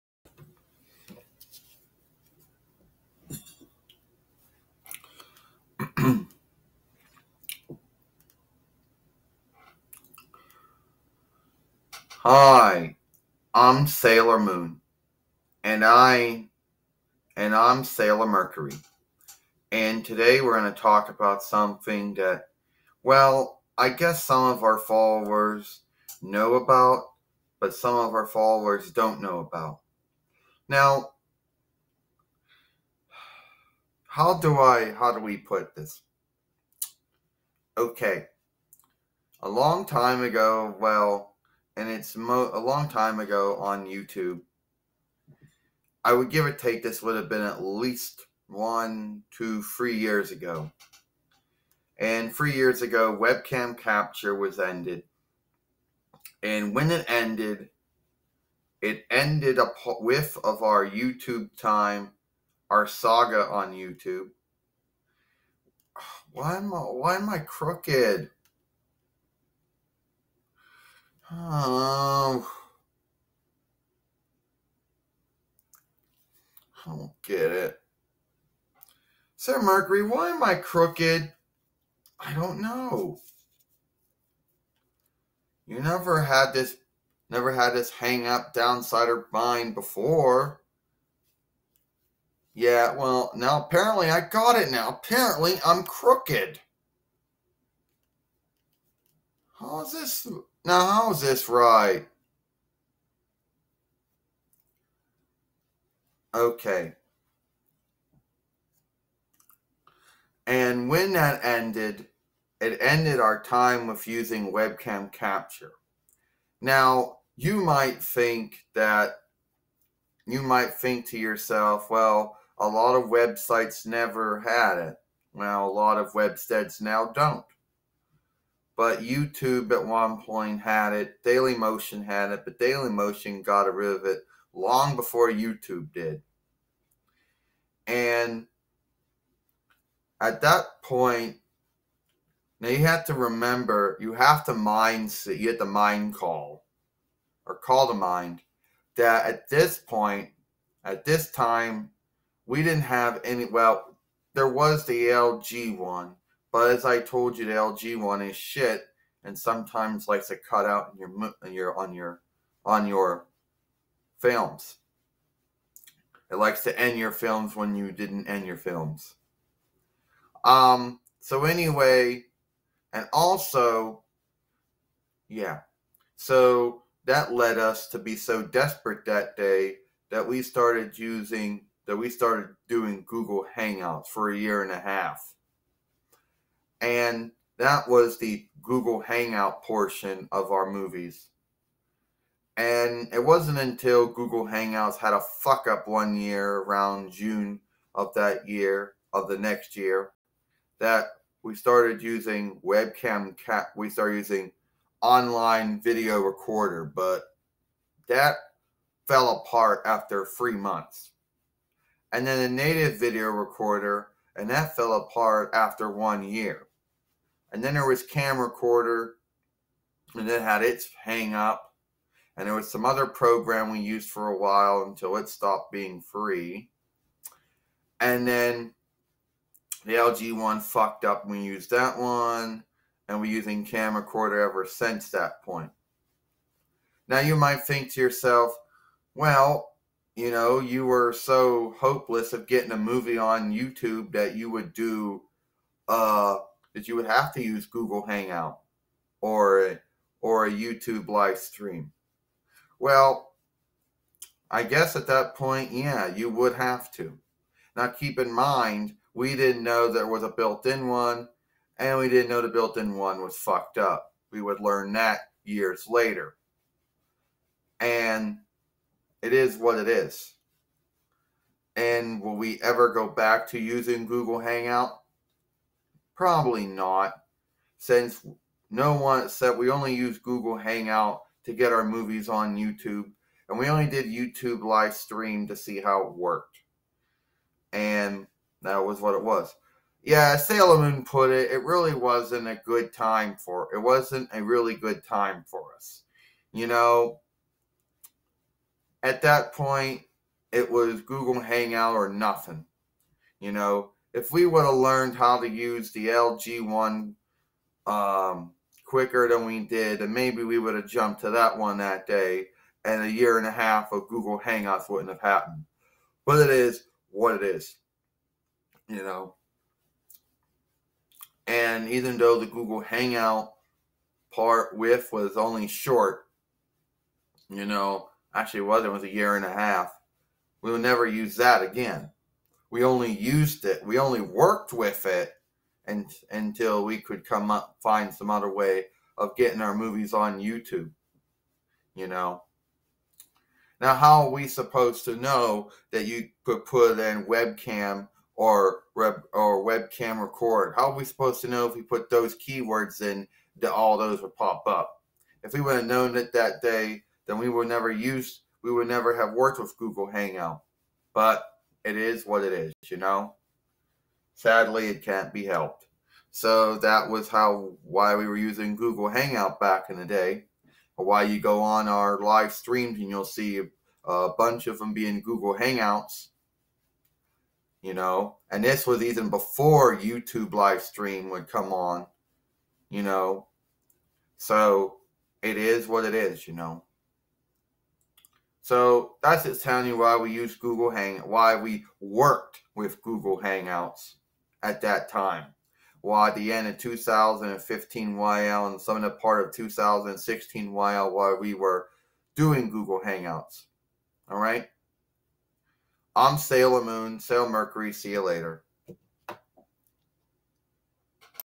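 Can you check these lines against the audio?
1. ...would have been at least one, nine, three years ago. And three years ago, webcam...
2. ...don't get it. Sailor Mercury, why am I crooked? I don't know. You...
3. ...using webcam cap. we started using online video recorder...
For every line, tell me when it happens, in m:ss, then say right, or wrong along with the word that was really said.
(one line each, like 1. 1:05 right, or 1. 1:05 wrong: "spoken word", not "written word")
1. 0:47 wrong: "two", not "nine"
2. 1:16 right
3. 3:22 right.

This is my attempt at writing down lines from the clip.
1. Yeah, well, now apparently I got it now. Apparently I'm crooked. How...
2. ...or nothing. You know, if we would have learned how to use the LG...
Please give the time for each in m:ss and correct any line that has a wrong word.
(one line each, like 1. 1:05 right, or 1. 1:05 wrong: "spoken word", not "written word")
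1. 1:32 right
2. 5:01 right.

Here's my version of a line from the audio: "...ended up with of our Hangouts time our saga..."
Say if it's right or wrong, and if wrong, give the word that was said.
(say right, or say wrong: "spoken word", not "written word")
wrong: "YouTube", not "Hangouts".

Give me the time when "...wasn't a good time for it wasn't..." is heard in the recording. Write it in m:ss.
4:51.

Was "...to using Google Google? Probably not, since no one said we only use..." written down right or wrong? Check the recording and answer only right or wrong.
wrong.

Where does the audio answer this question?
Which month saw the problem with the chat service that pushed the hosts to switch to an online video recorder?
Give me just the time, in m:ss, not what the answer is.
3:17.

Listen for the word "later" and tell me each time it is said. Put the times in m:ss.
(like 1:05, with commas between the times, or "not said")
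4:25, 6:48.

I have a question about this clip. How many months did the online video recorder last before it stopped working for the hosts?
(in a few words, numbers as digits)
3.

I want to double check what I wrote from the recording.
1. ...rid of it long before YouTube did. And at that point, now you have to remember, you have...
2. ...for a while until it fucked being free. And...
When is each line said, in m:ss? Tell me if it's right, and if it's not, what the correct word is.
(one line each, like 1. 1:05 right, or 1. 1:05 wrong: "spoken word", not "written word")
1. 2:13 right
2. 3:44 wrong: "stopped", not "fucked".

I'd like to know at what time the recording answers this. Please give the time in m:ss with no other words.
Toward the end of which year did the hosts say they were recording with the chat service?
6:36.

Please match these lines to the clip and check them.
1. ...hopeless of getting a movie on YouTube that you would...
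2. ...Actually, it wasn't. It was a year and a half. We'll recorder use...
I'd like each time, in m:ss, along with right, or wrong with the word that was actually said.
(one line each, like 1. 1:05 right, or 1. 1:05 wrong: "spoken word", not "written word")
1. 4:01 right
2. 5:28 wrong: "never", not "recorder".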